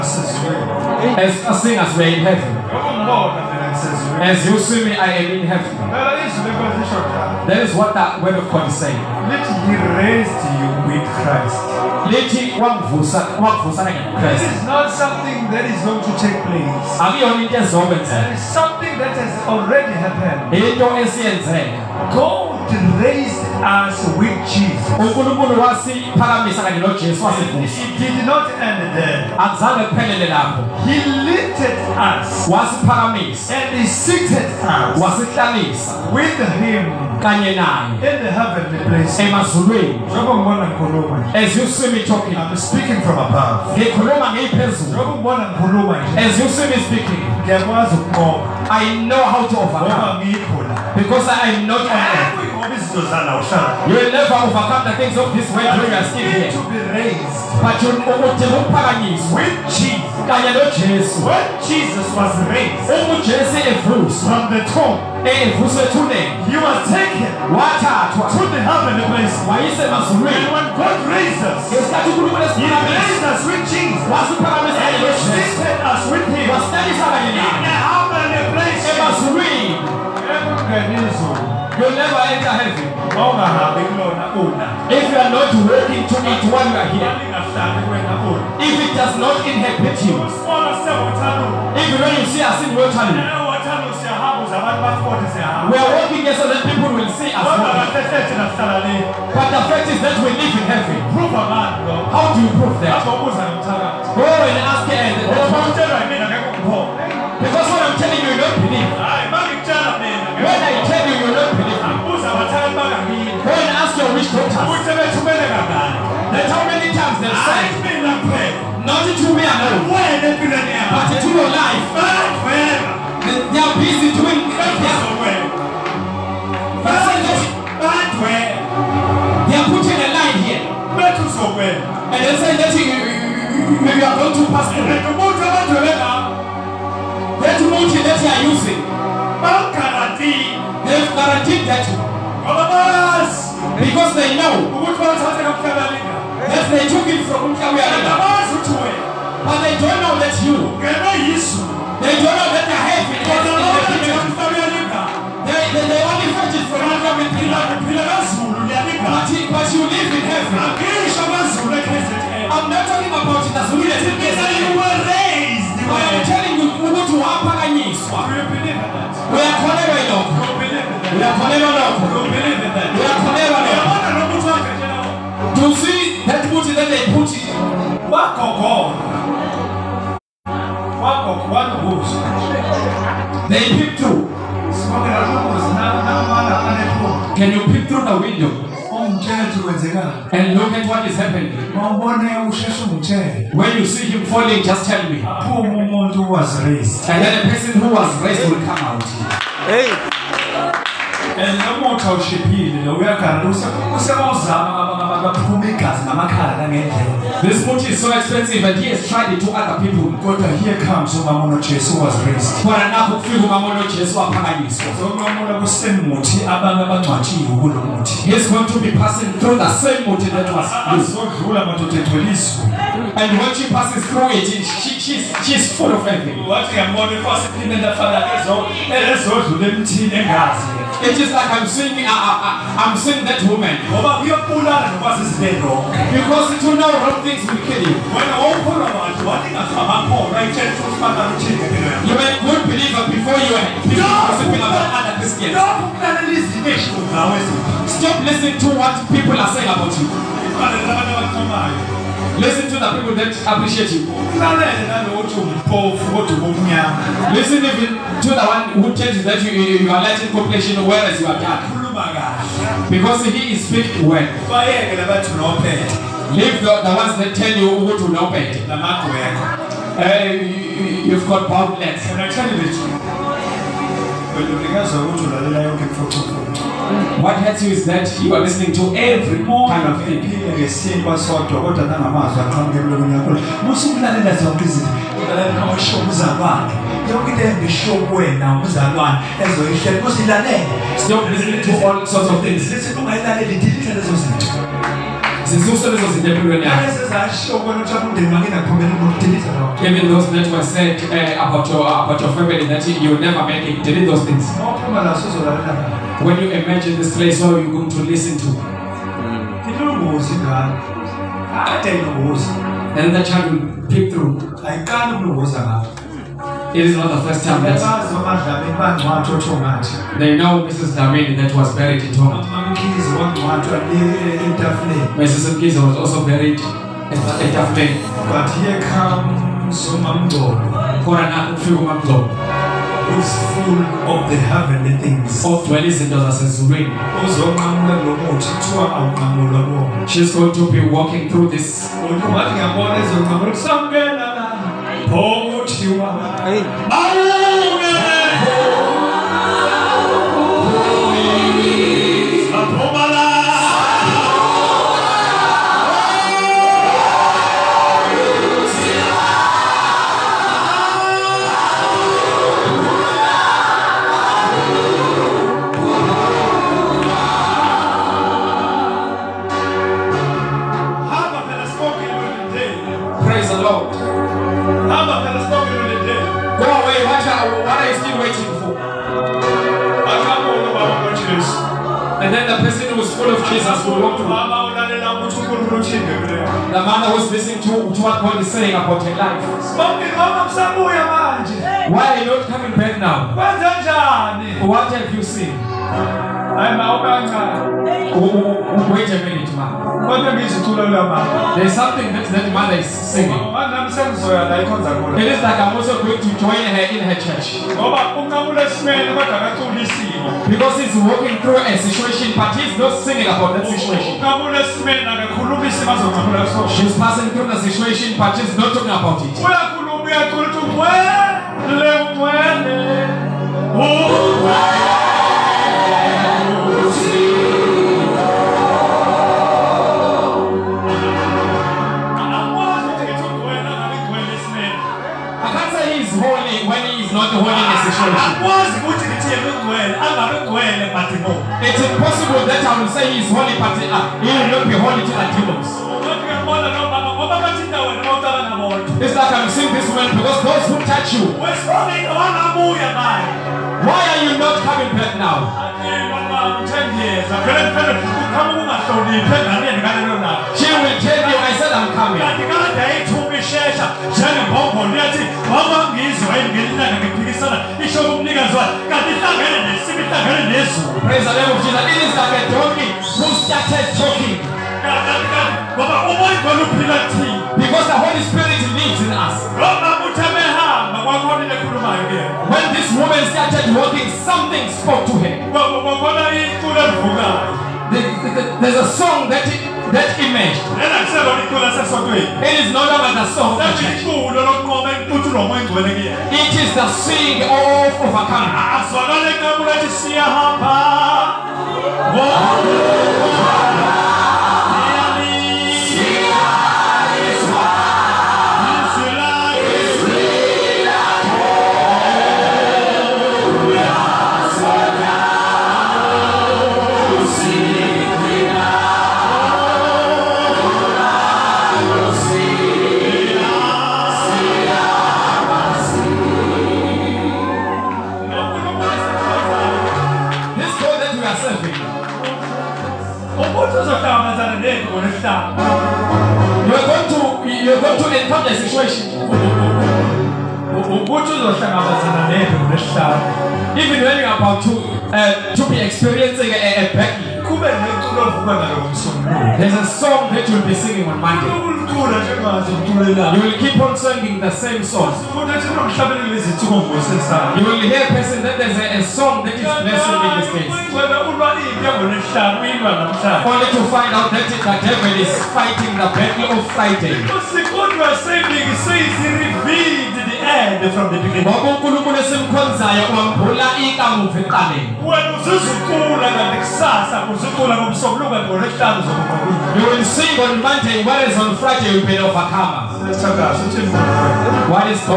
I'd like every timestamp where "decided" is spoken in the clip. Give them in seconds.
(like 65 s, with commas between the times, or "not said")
not said.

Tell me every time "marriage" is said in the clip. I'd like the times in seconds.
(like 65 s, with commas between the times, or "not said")
not said.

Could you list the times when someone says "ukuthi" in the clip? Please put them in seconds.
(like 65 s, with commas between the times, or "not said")
166 s, 540 s.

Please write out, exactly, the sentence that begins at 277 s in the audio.
What hurts you is that you are listening to every kind of thing.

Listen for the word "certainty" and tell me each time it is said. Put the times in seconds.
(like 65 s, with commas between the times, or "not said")
not said.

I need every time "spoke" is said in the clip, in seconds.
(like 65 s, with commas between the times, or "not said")
484 s.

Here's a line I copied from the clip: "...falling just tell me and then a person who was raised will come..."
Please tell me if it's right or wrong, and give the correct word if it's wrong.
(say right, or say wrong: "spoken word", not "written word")
right.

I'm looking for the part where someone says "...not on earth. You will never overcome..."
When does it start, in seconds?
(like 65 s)
51 s.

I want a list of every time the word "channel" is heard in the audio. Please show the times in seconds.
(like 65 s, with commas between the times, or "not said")
92 s.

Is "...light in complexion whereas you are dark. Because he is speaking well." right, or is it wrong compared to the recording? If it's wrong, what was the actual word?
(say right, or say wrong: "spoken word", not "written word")
right.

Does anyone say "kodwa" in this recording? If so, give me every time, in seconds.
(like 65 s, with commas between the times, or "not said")
210 s, 281 s.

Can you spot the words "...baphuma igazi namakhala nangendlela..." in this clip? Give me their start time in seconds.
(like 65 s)
205 s.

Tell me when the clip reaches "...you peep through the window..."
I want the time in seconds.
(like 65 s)
187 s.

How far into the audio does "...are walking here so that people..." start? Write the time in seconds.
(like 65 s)
95 s.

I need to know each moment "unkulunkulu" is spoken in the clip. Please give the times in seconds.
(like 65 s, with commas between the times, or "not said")
24 s, 571 s.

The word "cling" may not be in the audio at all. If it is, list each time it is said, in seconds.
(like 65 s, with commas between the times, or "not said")
not said.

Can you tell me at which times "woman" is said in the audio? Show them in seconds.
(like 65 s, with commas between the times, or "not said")
233 s, 482 s.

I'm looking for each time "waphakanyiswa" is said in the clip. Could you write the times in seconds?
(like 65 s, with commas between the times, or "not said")
167 s, 214 s.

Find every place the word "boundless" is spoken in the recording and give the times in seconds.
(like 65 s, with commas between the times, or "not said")
271 s.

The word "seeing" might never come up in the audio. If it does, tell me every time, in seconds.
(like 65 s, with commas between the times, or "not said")
226 s, 232 s, 496 s.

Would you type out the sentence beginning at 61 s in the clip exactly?
When Jesus was raised from the tomb, he was taken to the heavenly place.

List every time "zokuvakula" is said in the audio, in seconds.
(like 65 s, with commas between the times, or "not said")
579 s.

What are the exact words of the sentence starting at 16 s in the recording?
It is something that has already happened.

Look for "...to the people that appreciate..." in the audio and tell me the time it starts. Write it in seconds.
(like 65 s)
252 s.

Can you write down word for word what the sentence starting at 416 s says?
She's passing through the situation, but she's not talking about it.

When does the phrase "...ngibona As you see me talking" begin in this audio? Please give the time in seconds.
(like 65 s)
40 s.